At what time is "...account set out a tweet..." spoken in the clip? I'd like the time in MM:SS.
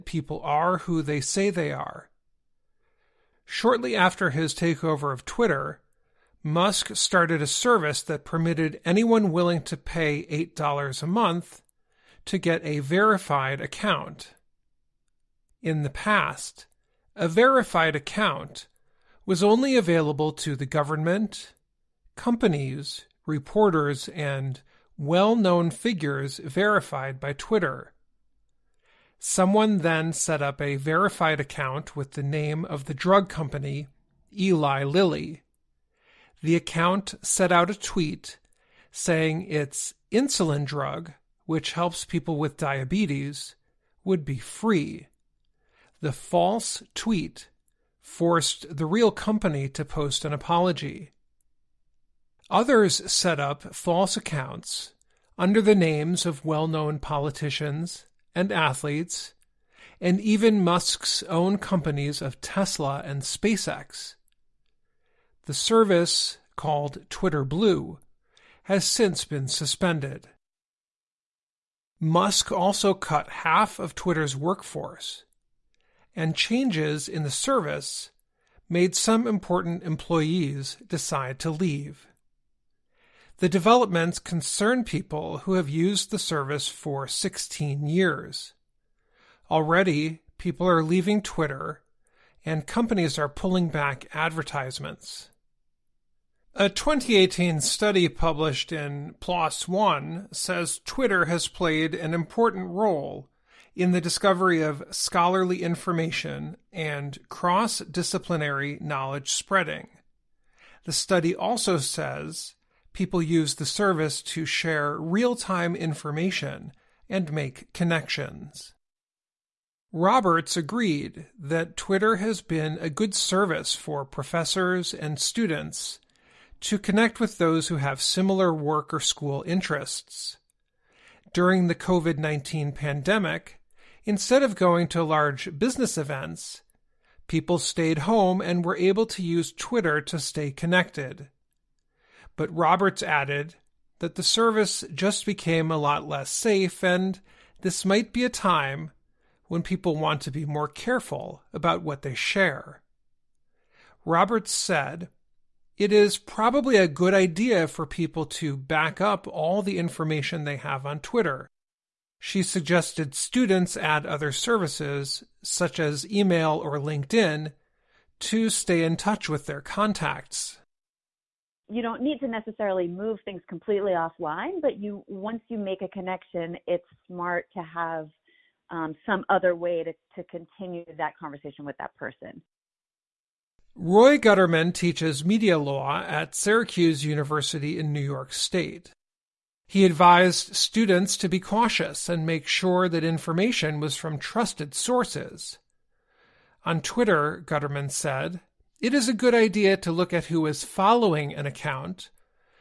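00:36.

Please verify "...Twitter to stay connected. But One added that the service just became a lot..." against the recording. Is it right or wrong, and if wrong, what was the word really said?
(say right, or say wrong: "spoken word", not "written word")
wrong: "Roberts", not "One".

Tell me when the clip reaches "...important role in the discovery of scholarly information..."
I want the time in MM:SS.
01:42.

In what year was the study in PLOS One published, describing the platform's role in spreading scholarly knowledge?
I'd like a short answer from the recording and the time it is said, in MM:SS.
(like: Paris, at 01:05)
2018, at 01:36.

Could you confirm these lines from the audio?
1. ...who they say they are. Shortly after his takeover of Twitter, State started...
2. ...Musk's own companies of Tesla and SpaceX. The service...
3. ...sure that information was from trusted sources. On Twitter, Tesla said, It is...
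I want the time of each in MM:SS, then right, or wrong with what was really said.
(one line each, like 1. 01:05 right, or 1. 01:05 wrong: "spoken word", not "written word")
1. 00:00 wrong: "Musk", not "State"
2. 01:00 right
3. 03:12 wrong: "Gutterman", not "Tesla".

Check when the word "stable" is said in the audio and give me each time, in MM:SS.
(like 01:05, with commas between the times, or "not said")
not said.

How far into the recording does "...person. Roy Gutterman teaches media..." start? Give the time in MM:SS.
03:01.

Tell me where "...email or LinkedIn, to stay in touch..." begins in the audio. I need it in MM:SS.
02:46.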